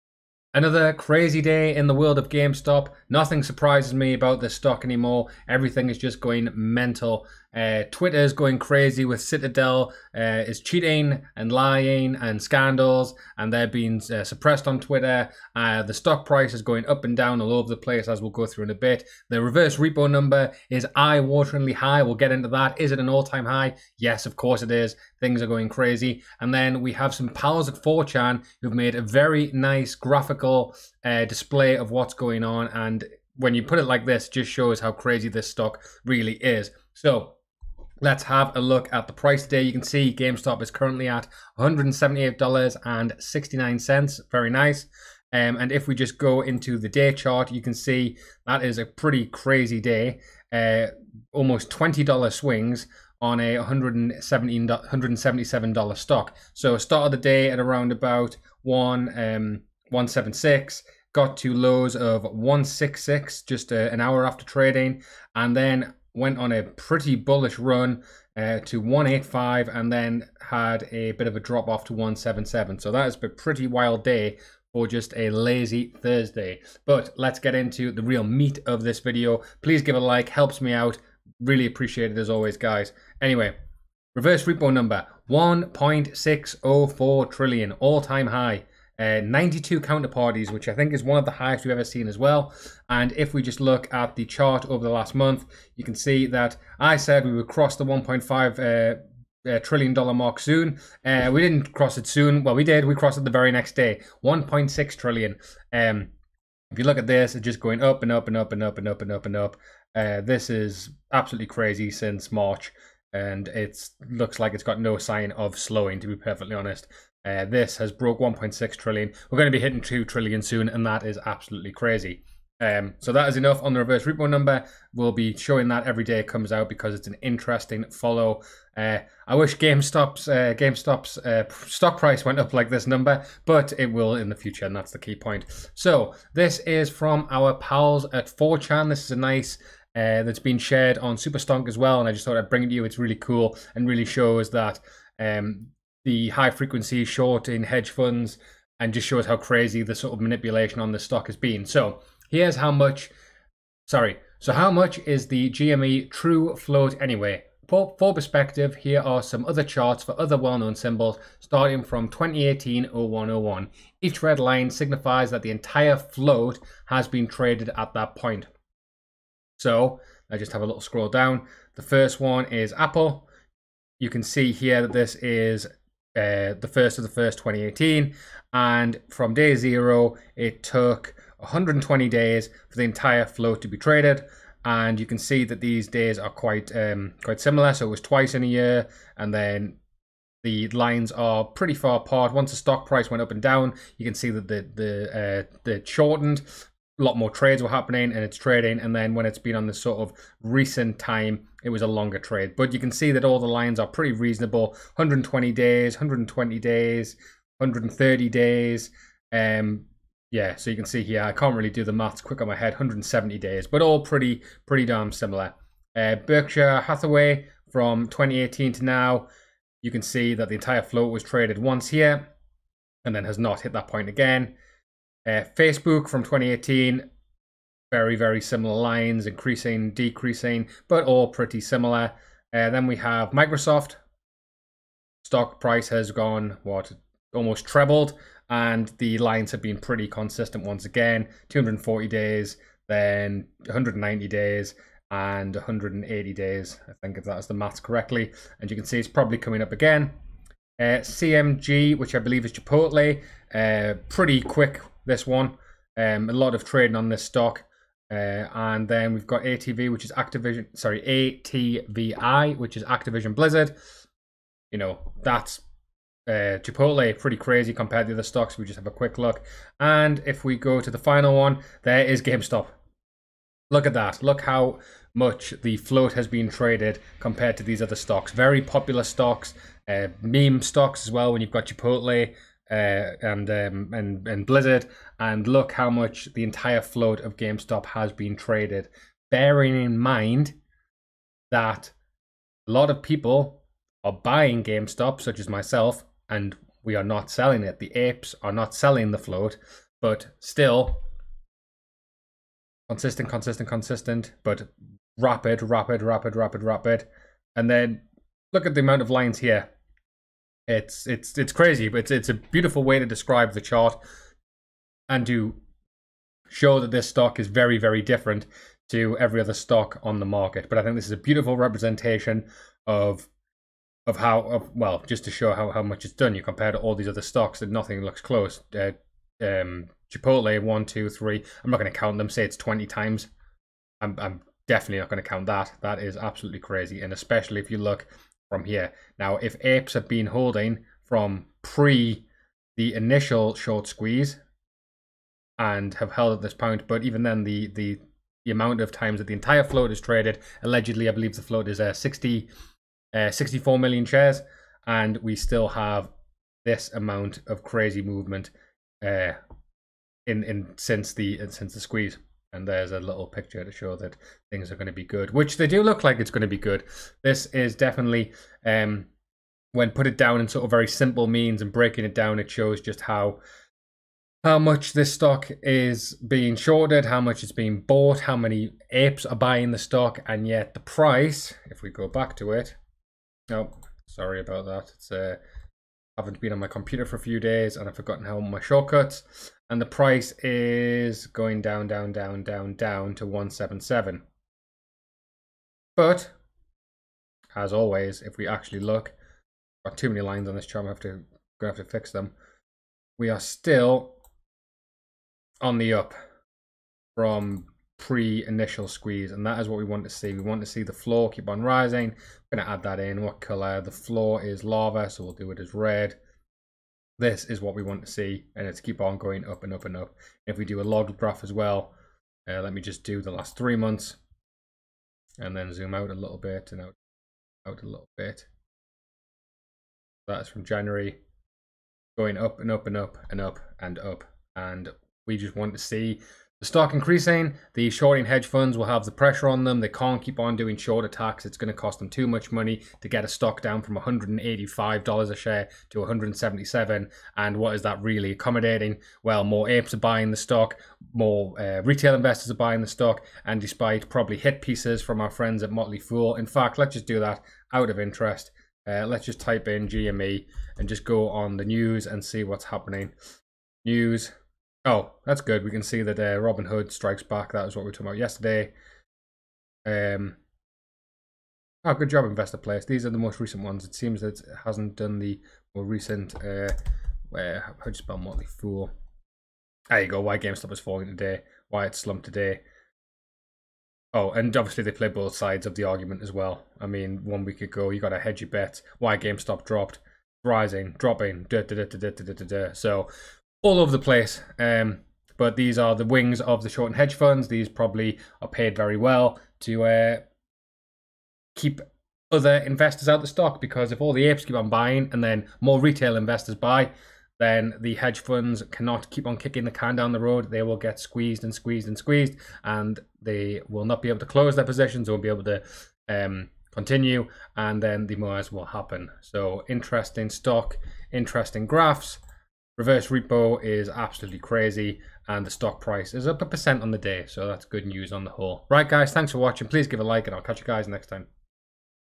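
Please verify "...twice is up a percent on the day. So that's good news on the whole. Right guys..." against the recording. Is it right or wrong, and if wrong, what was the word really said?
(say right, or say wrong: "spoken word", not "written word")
wrong: "price", not "twice".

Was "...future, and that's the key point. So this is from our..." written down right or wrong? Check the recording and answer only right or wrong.
right.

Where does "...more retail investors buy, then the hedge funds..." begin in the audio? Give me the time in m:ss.
8:25.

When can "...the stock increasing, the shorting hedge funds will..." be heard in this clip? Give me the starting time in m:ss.
7:16.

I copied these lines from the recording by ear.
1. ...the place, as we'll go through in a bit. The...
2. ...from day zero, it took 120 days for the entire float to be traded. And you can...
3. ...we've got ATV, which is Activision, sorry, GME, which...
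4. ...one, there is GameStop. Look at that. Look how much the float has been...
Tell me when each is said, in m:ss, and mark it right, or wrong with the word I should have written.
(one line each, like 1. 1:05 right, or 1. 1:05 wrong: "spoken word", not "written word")
1. 0:17 right
2. 2:59 right
3. 4:19 wrong: "ATVI", not "GME"
4. 4:31 right.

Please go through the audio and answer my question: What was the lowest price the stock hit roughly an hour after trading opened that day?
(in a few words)
166.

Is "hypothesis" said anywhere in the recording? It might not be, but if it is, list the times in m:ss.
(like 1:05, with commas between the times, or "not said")
not said.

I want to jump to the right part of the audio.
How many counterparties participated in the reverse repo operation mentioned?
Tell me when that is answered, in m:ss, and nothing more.
1:29.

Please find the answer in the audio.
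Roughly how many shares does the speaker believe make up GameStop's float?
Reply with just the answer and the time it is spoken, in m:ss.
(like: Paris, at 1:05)
64 million, at 5:53.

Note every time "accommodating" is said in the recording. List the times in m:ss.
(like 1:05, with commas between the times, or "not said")
7:28.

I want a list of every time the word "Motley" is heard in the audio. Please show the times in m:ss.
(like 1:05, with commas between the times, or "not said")
7:35, 7:58.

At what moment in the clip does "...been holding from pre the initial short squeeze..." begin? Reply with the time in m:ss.
5:40.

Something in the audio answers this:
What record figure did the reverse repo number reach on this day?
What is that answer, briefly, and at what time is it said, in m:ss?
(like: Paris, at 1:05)
1.604 trillion, at 1:25.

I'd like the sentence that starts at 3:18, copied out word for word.
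And then when it's been on this sort of recent time, it was a longer trade.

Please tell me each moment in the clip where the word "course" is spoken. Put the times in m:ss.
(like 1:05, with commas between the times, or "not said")
0:24.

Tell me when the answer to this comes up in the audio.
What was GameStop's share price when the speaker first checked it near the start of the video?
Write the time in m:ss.
0:41.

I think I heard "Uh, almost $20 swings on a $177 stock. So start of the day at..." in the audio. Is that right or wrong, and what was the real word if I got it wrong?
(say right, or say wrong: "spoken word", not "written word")
right.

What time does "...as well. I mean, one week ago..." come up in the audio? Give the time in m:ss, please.
8:06.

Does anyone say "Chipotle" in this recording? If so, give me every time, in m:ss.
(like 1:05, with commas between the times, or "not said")
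4:12, 4:26, 4:41, 5:30.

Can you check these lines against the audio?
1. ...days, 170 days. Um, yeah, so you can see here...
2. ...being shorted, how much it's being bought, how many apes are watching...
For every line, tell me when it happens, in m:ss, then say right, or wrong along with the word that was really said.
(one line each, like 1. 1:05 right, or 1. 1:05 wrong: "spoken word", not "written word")
1. 3:26 wrong: "130", not "170"
2. 6:16 wrong: "buying", not "watching".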